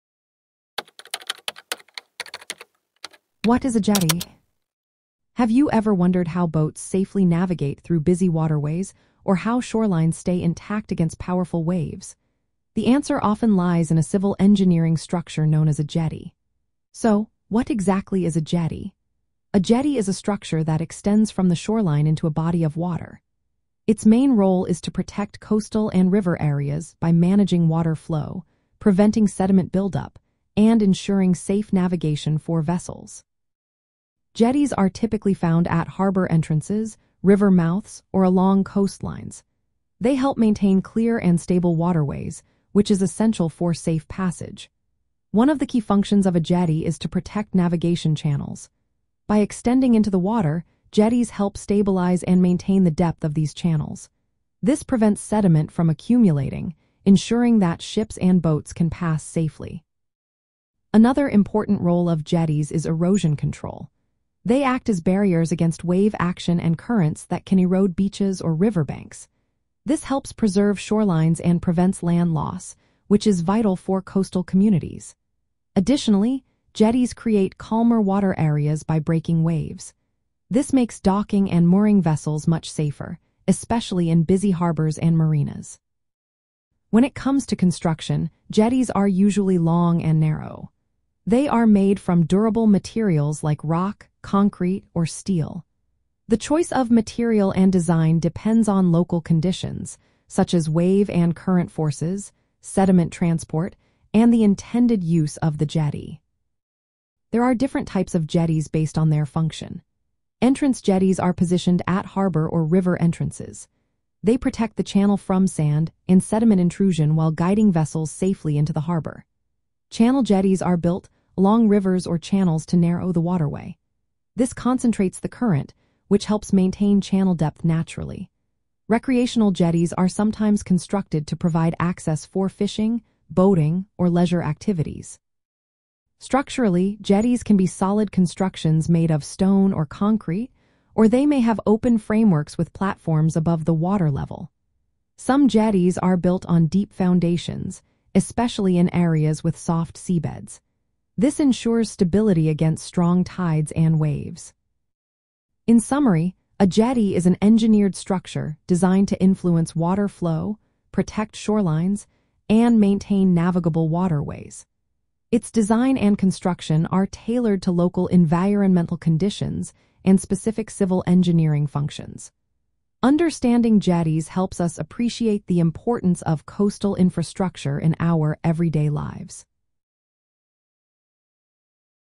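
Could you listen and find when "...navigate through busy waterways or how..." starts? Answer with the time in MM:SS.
00:07.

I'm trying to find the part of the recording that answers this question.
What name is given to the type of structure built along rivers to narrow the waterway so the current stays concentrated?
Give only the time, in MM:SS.
01:59.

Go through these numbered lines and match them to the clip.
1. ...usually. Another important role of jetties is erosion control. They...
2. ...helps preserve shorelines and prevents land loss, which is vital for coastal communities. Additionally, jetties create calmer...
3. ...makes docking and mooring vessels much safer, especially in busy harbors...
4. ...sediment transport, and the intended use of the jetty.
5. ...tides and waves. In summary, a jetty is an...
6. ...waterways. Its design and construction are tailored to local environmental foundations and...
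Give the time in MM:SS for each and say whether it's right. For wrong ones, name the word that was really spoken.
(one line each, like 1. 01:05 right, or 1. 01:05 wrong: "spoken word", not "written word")
1. 00:59 wrong: "safely", not "usually"
2. 01:10 right
3. 01:20 right
4. 01:42 right
5. 02:33 right
6. 02:43 wrong: "conditions", not "foundations".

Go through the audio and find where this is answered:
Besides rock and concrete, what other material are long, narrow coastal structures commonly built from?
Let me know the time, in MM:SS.
01:35.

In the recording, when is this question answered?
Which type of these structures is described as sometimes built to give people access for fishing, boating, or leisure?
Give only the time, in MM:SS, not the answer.
02:08.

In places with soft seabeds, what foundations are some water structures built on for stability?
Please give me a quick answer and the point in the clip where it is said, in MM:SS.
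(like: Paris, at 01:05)
deep foundations, at 02:26.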